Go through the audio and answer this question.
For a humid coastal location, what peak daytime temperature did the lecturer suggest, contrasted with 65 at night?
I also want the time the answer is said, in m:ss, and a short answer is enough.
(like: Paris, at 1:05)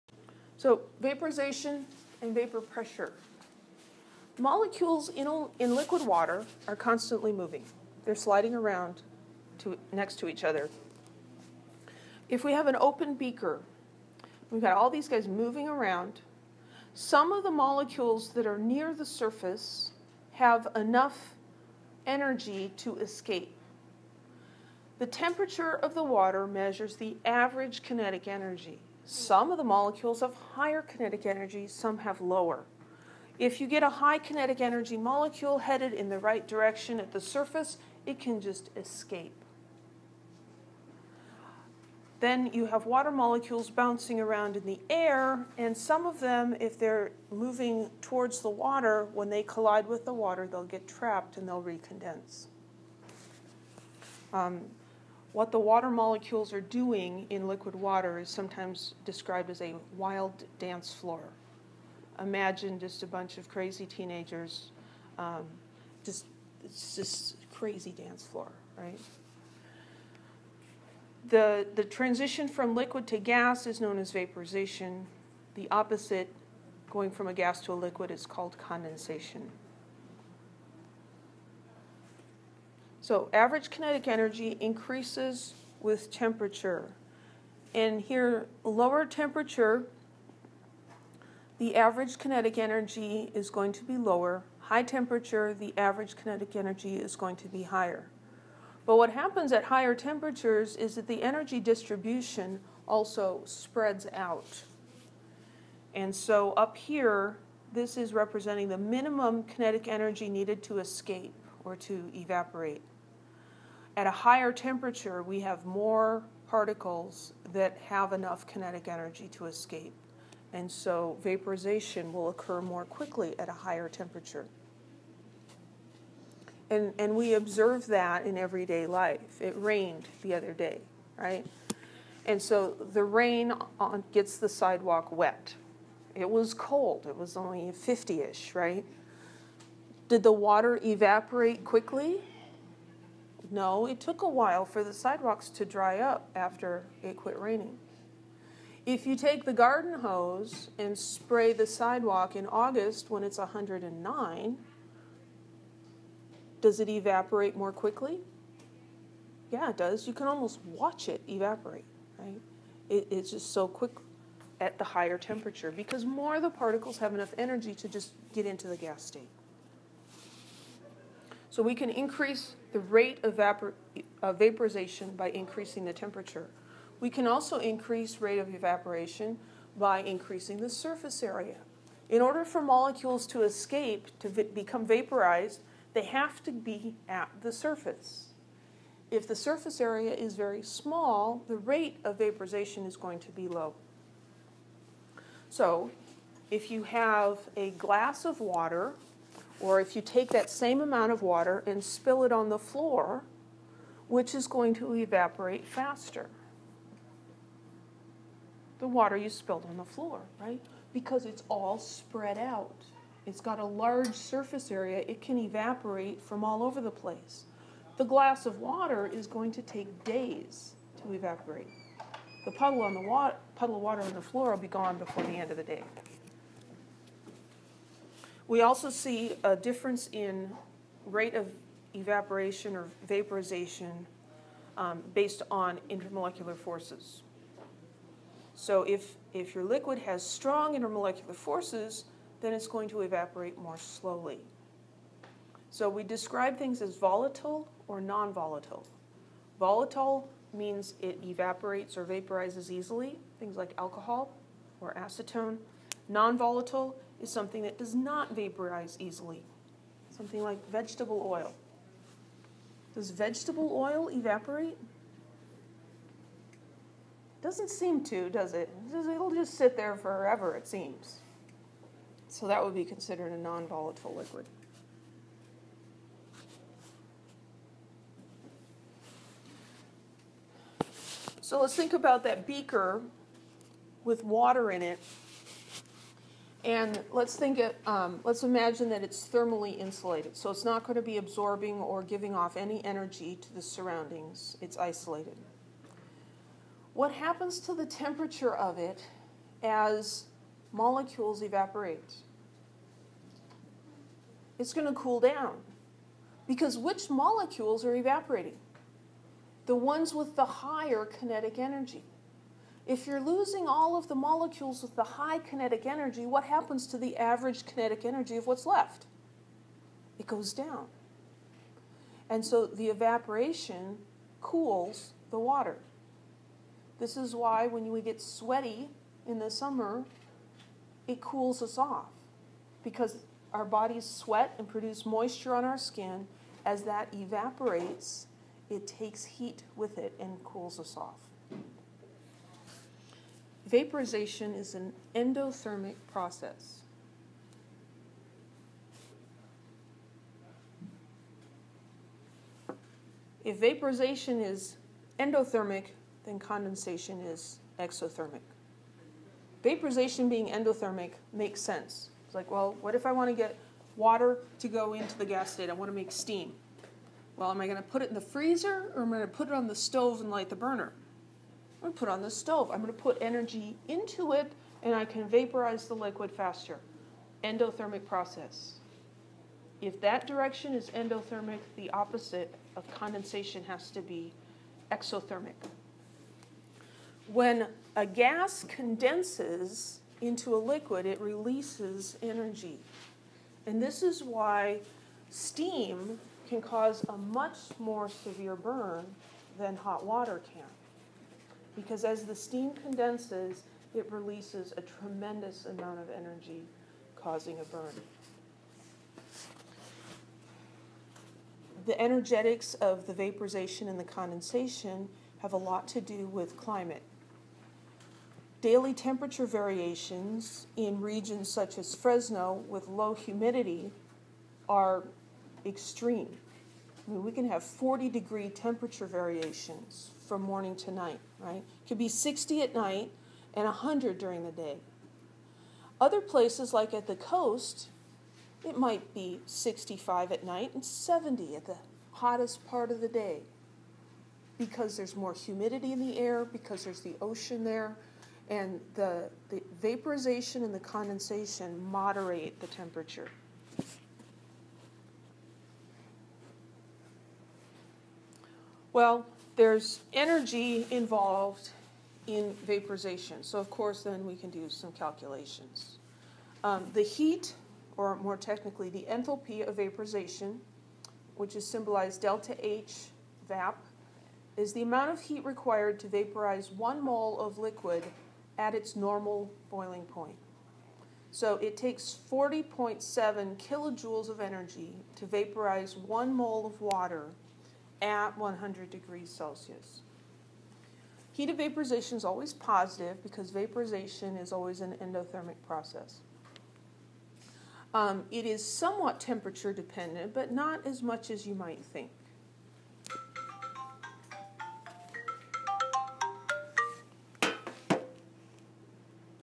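70, at 7:20.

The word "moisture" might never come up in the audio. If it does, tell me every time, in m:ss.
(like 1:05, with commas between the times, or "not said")
5:35.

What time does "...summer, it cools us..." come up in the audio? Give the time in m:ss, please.
5:29.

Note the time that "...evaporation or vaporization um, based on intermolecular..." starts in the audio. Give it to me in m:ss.
3:51.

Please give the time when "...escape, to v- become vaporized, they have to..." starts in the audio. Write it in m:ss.
3:03.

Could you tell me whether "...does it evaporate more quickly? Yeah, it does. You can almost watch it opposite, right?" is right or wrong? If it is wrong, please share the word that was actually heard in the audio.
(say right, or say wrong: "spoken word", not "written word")
wrong: "evaporate", not "opposite".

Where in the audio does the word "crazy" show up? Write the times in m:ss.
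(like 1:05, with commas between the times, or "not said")
1:03, 1:07.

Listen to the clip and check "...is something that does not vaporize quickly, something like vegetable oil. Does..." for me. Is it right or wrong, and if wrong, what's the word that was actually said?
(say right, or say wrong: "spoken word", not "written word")
wrong: "easily", not "quickly".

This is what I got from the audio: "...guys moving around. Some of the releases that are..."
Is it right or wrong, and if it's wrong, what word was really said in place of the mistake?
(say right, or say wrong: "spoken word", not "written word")
wrong: "molecules", not "releases".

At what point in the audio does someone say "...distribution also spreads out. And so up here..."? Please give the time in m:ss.
1:41.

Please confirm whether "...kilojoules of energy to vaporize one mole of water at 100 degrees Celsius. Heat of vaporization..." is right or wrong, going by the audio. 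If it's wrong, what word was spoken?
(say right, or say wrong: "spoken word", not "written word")
right.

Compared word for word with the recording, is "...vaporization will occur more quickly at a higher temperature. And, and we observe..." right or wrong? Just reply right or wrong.
right.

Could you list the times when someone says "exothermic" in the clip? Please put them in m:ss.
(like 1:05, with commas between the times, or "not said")
5:57, 6:24.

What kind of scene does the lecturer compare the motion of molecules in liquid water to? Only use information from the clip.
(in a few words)
A wild dance floor.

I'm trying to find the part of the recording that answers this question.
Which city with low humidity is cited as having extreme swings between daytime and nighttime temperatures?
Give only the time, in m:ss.
7:01.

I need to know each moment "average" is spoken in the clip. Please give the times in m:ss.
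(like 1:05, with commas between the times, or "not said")
0:27, 1:23, 1:31, 1:35, 5:17.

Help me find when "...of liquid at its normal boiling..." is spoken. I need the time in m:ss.
7:57.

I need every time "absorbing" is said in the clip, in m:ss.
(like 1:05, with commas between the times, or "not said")
4:51.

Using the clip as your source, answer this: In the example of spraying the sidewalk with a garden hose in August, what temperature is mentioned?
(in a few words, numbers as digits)
109.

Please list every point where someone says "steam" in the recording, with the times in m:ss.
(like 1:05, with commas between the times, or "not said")
6:06, 6:35, 6:42.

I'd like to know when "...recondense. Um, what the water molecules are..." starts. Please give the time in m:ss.
0:51.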